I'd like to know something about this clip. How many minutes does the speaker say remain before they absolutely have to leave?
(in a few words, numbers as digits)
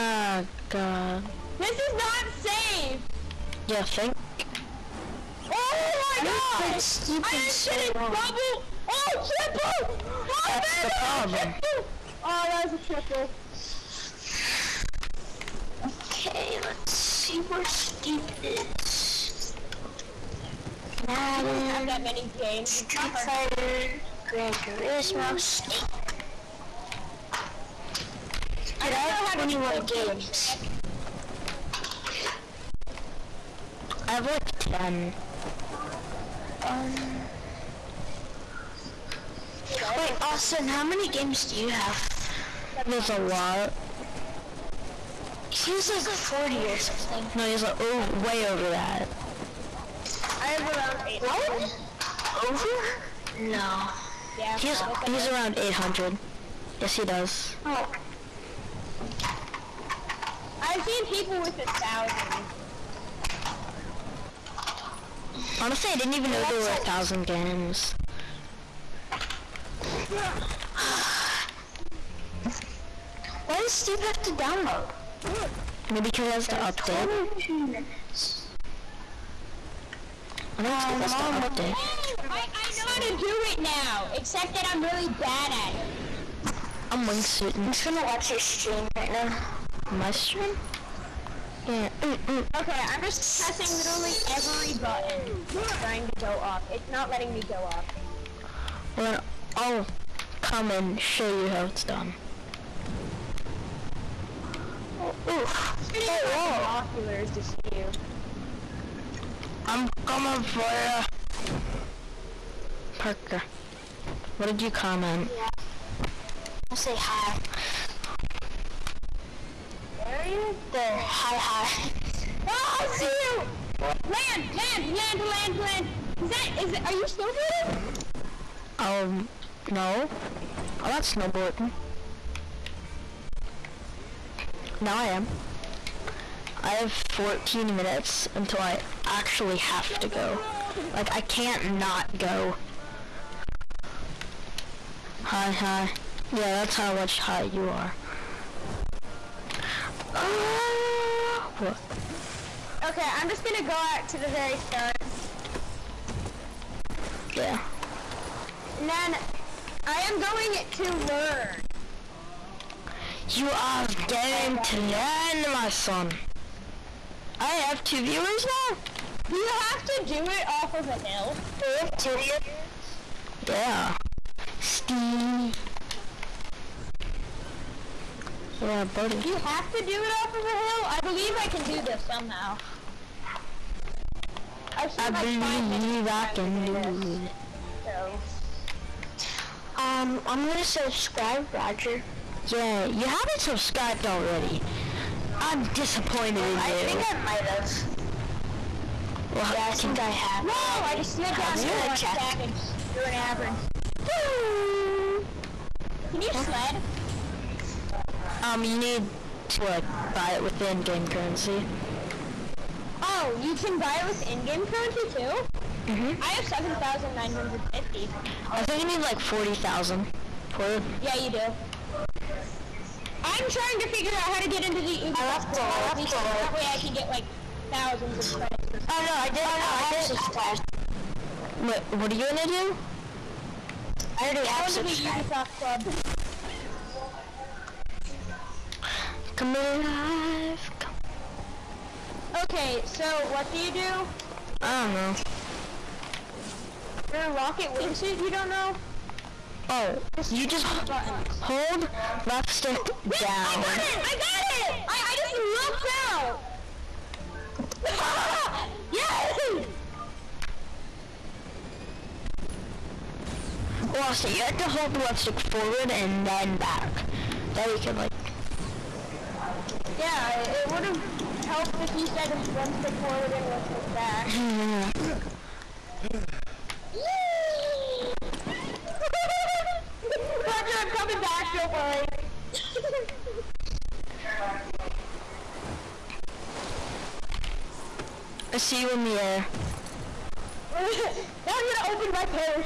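14.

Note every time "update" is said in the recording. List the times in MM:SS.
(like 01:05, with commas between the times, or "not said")
01:16, 01:21.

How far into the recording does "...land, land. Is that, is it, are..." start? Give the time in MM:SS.
02:05.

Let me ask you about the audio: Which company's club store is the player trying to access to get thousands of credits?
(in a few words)
Ubisoft.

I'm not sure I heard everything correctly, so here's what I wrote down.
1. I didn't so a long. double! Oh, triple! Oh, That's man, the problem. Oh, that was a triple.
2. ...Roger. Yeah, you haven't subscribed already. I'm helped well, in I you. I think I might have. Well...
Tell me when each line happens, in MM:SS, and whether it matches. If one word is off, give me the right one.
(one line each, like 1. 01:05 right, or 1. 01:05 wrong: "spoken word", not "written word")
1. 00:06 right
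2. 03:11 wrong: "disappointed", not "helped".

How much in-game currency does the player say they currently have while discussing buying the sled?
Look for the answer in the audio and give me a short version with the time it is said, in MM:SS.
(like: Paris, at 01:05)
7950, at 03:36.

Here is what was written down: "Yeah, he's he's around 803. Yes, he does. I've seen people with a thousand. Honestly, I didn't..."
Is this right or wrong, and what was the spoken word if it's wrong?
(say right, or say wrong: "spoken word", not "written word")
wrong: "800", not "803".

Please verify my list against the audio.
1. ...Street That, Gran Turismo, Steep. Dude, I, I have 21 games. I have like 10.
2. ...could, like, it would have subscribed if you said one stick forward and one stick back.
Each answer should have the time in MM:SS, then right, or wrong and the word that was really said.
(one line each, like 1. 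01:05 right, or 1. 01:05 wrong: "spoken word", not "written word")
1. 00:22 wrong: "Fighter", not "That"
2. 04:27 wrong: "helped", not "subscribed".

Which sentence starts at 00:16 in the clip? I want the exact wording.
Okay, let's see where Steep is.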